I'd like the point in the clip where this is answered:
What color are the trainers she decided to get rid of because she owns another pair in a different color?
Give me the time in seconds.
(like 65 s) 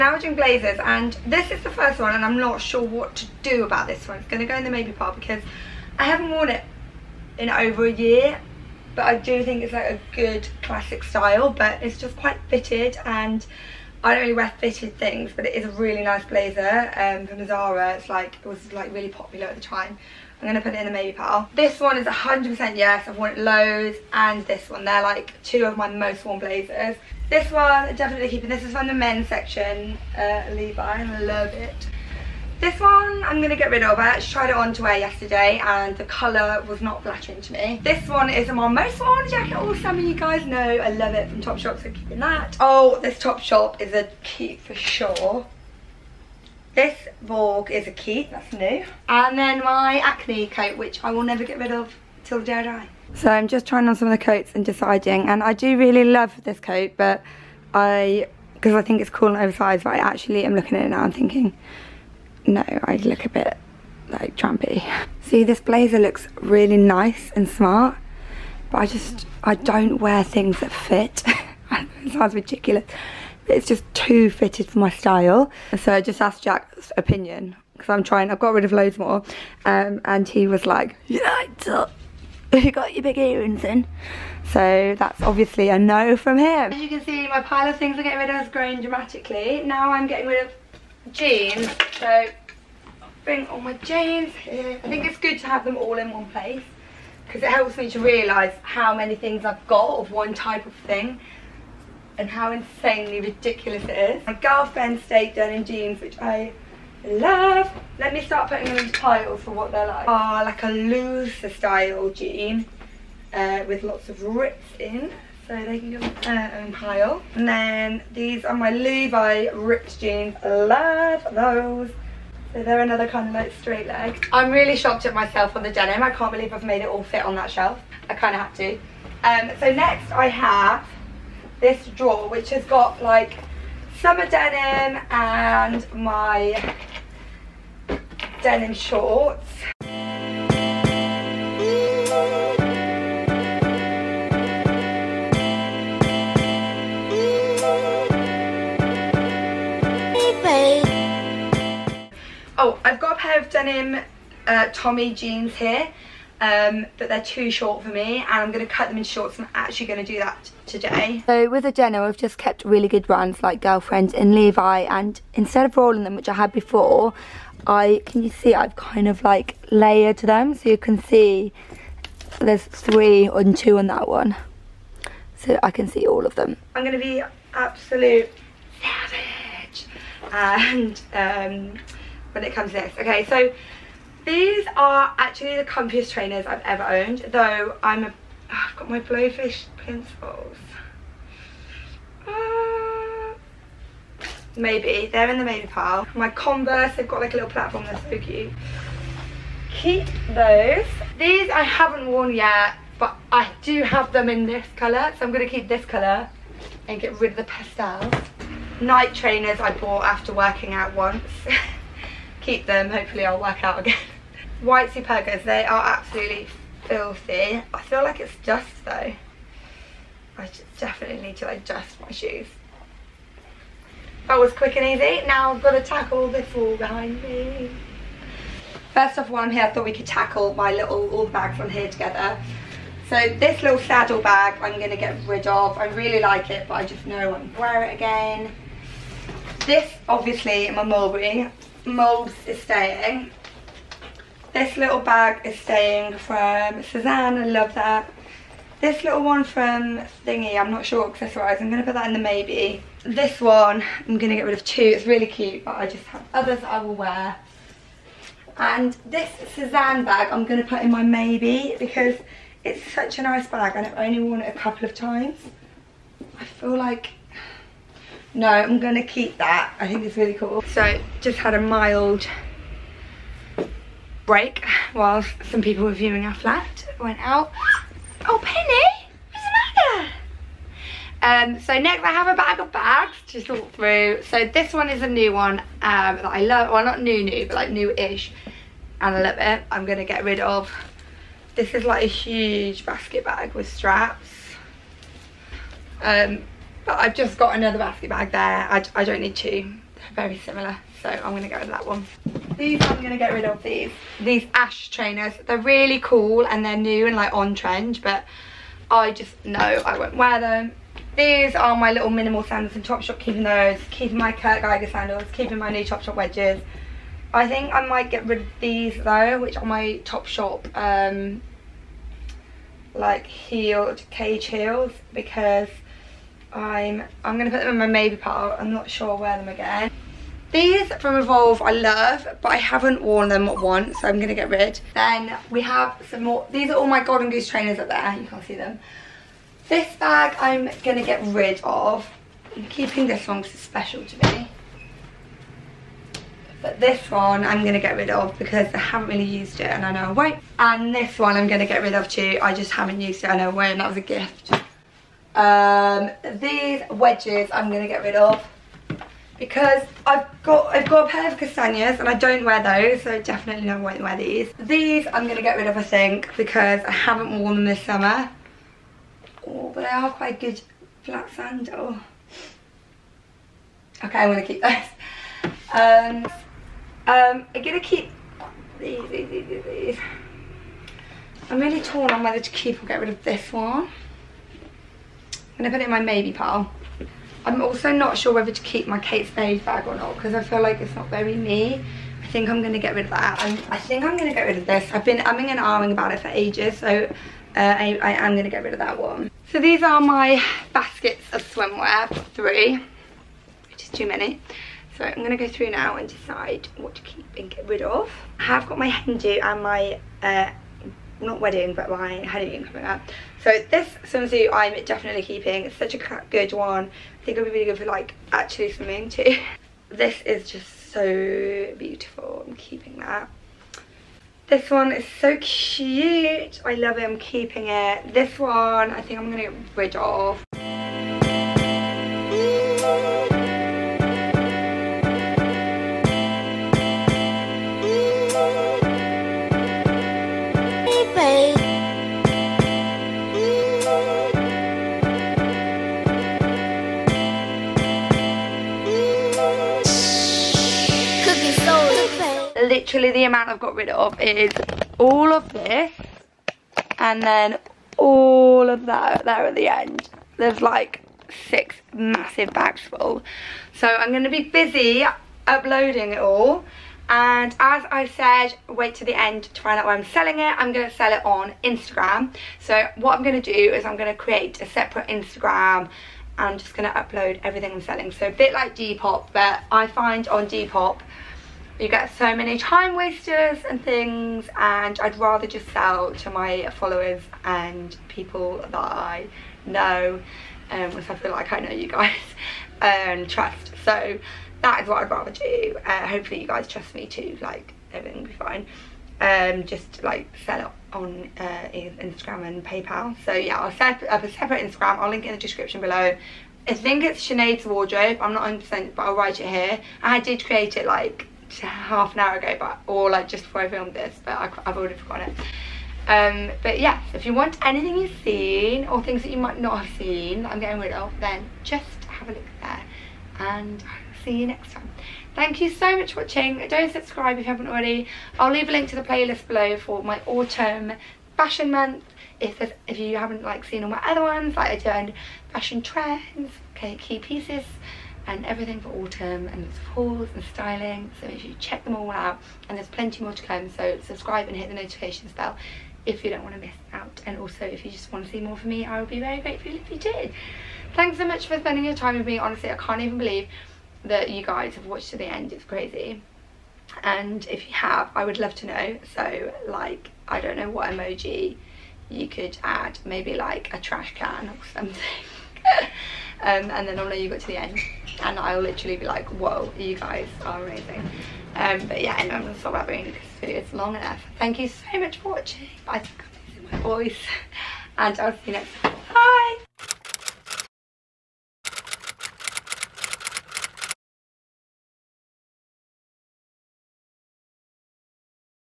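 207 s.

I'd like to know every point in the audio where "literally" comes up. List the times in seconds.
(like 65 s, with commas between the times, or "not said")
452 s, 568 s.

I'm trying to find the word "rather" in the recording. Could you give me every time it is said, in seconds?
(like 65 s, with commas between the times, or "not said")
485 s, 495 s.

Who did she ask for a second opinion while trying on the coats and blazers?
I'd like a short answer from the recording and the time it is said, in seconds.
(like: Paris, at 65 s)
Jack, at 76 s.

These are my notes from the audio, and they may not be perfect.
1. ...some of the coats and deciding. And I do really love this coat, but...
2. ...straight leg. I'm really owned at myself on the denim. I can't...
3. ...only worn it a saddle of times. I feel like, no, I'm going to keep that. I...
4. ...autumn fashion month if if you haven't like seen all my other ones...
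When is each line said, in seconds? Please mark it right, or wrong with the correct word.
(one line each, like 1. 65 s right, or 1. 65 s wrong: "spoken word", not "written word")
1. 53 s right
2. 123 s wrong: "shocked", not "owned"
3. 263 s wrong: "couple", not "saddle"
4. 530 s right.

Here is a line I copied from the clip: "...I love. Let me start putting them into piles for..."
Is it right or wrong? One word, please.
right.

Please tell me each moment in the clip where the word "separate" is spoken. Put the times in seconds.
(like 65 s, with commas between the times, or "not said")
474 s, 504 s.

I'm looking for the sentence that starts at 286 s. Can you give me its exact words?
Well, not new new, but like new-ish.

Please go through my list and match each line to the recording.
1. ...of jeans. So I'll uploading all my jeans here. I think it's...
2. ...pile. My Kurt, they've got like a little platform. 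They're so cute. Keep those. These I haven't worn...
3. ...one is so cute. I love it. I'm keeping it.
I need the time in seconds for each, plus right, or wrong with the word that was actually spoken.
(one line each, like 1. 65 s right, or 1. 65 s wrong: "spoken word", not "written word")
1. 90 s wrong: "bring", not "uploading"
2. 195 s wrong: "Converse", not "Kurt"
3. 424 s right.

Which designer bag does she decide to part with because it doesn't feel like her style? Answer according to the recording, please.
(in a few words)
Kate Spade.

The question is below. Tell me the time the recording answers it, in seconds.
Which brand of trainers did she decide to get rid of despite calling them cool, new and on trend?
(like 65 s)
304 s.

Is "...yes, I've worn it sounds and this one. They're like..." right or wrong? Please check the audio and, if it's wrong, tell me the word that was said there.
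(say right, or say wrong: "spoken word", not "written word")
wrong: "loads", not "sounds".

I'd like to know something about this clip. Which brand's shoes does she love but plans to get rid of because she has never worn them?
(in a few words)
Evolve.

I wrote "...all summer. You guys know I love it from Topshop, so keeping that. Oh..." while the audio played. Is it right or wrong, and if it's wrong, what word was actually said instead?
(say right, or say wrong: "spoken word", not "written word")
right.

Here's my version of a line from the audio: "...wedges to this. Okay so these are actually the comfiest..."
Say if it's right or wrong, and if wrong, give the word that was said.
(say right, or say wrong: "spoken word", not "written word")
wrong: "comes", not "wedges".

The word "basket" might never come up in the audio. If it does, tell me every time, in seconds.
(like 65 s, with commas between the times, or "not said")
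292 s, 297 s, 400 s.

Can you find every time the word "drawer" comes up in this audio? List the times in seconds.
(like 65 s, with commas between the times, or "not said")
131 s.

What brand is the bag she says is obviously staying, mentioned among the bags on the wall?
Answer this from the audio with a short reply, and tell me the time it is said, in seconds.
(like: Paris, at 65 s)
Mulberry, at 240 s.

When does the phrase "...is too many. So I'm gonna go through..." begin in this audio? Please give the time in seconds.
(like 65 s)
403 s.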